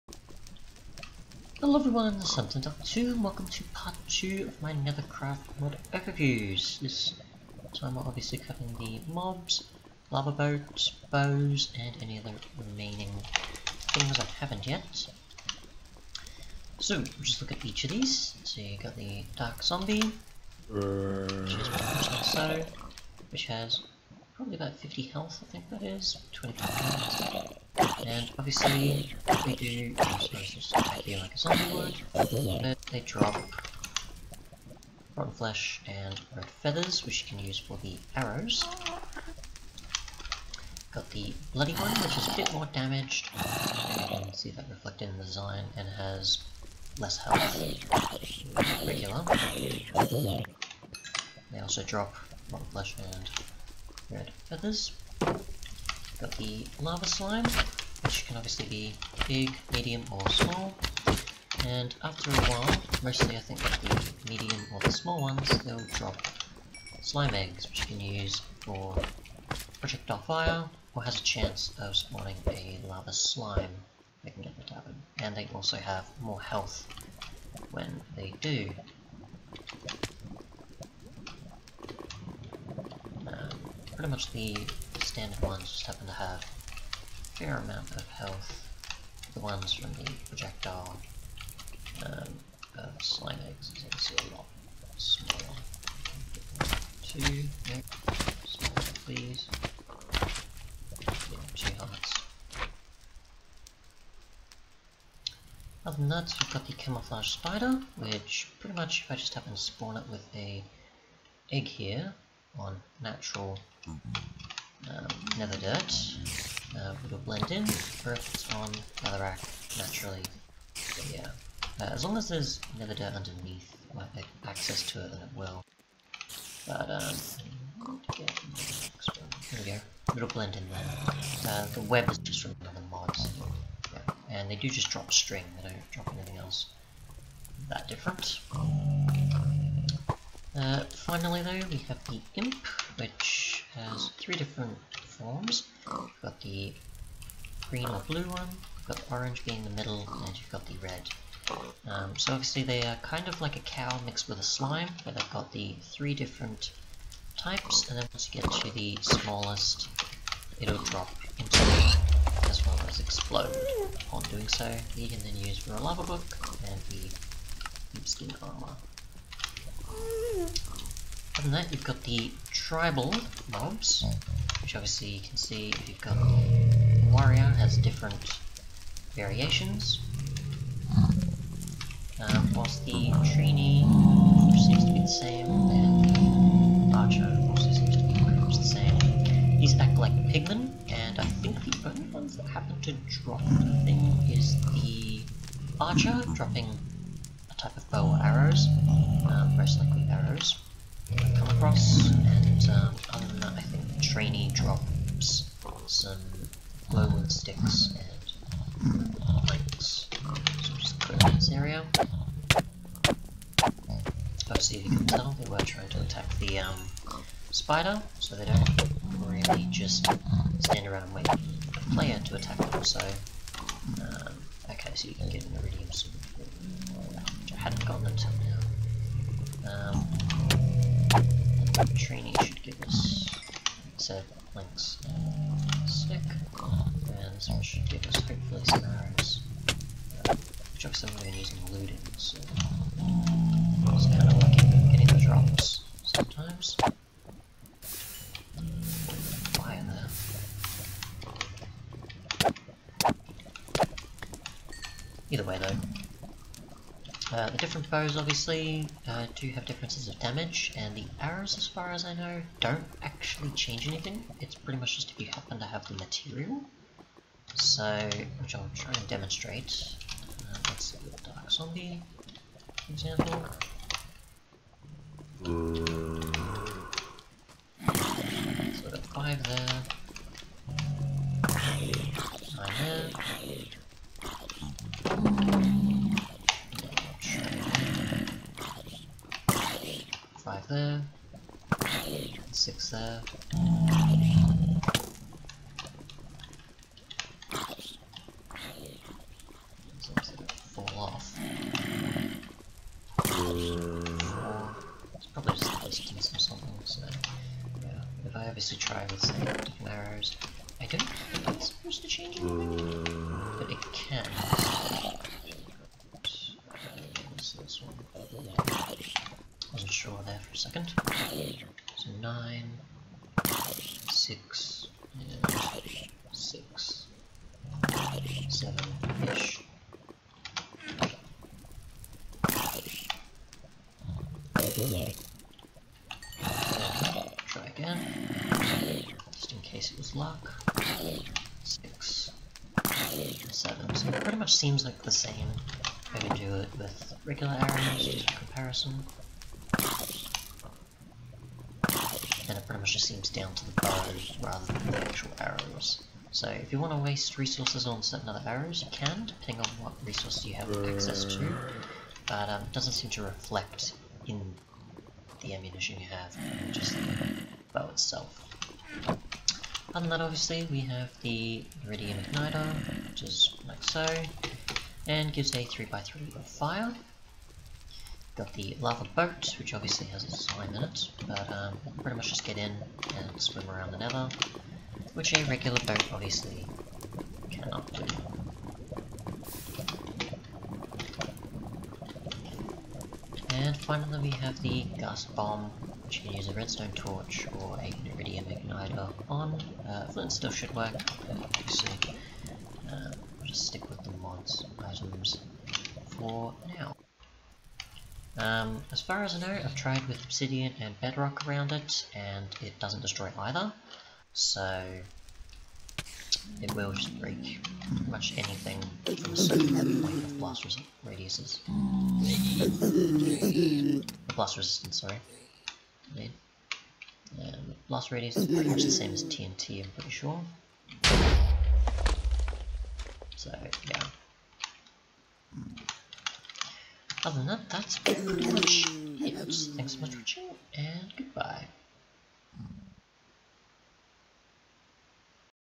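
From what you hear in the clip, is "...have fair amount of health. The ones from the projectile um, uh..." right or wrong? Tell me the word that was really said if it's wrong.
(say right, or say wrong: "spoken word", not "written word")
right.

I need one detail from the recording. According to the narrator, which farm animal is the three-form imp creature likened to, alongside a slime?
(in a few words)
cow.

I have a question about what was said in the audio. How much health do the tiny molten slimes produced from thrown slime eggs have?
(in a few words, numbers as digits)
2 hearts.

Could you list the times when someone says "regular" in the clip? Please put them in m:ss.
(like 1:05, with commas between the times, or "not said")
0:48, 5:47, 6:25.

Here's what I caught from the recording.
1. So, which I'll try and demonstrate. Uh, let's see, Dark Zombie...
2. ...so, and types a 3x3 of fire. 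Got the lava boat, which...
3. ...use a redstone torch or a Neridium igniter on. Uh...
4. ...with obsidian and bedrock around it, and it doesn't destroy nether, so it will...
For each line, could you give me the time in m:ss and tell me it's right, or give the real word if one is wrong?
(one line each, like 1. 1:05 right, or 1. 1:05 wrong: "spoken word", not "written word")
1. 4:27 right
2. 6:13 wrong: "gives", not "types"
3. 6:36 right
4. 6:50 wrong: "either", not "nether".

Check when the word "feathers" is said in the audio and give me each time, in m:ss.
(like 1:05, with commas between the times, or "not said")
0:36, 0:54.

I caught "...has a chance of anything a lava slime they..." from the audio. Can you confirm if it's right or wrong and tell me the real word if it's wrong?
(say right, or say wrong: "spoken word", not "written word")
wrong: "spawning", not "anything".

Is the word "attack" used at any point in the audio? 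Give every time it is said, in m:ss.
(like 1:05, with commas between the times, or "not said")
3:36, 3:42.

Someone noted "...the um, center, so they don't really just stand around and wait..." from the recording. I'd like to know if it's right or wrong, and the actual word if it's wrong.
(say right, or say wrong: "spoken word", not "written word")
wrong: "spider", not "center".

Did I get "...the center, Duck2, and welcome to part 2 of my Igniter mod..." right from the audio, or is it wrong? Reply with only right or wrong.
wrong.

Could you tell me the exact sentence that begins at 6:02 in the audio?
But um, it doesn't seem to reflect in the ammunition you have, just the bow itself.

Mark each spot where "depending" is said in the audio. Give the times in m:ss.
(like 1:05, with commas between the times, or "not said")
5:59.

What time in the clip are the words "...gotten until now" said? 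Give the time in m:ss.
3:47.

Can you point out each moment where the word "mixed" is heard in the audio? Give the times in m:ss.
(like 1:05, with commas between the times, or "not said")
2:34.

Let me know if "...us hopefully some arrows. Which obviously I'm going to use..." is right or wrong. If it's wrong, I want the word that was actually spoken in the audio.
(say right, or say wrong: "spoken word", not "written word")
right.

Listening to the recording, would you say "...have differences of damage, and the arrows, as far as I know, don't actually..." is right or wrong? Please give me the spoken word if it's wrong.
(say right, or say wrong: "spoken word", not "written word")
right.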